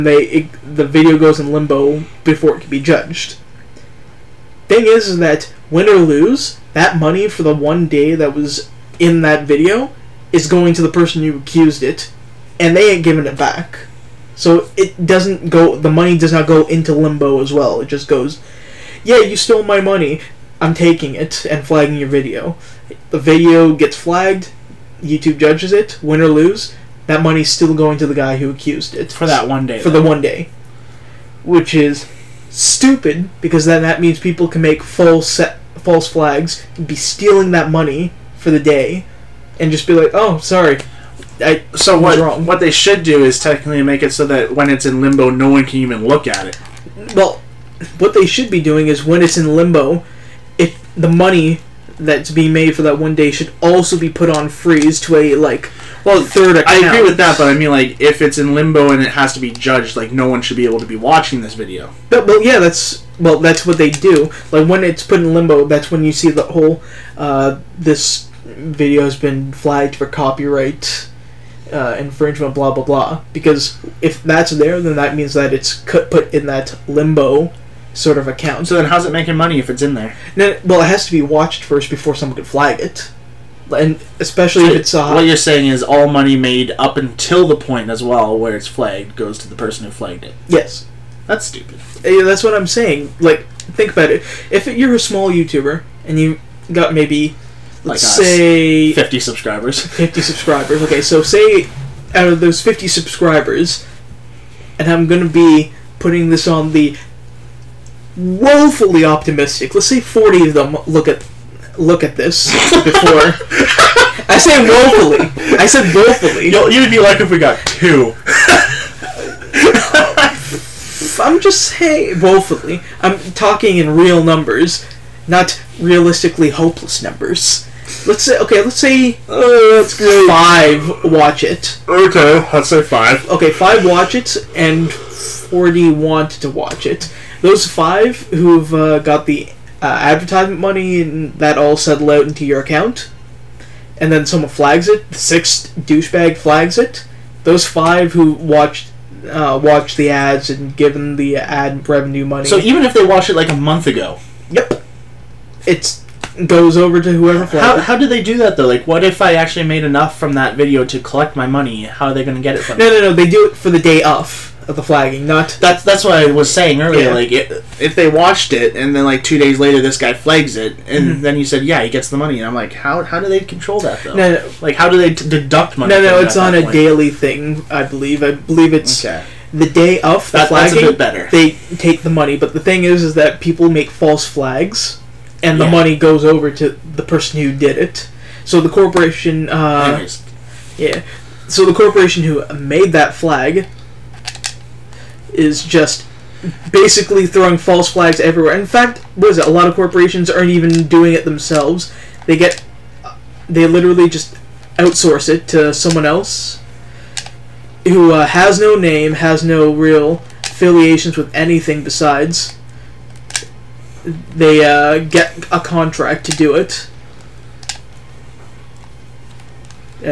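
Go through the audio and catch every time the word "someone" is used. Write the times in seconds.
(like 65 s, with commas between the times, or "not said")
82 s, 144 s, 205 s.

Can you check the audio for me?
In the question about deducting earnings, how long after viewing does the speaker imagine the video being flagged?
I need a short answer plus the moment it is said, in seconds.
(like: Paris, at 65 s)
two days later, at 169 s.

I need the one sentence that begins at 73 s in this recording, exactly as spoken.
Because if that's there, then that means that it's put in that limbo sort of account.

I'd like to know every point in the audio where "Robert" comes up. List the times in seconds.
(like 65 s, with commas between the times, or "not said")
not said.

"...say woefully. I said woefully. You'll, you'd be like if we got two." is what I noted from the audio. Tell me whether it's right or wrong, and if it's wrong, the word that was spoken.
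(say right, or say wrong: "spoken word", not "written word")
right.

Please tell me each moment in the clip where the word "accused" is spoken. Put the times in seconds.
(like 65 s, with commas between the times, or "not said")
11 s, 28 s.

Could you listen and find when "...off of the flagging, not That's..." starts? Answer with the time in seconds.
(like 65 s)
164 s.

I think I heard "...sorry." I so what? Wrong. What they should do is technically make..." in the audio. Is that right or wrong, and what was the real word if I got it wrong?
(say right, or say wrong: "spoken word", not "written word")
right.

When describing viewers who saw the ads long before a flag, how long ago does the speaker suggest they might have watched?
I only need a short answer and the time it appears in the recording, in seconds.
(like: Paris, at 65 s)
a month ago, at 153 s.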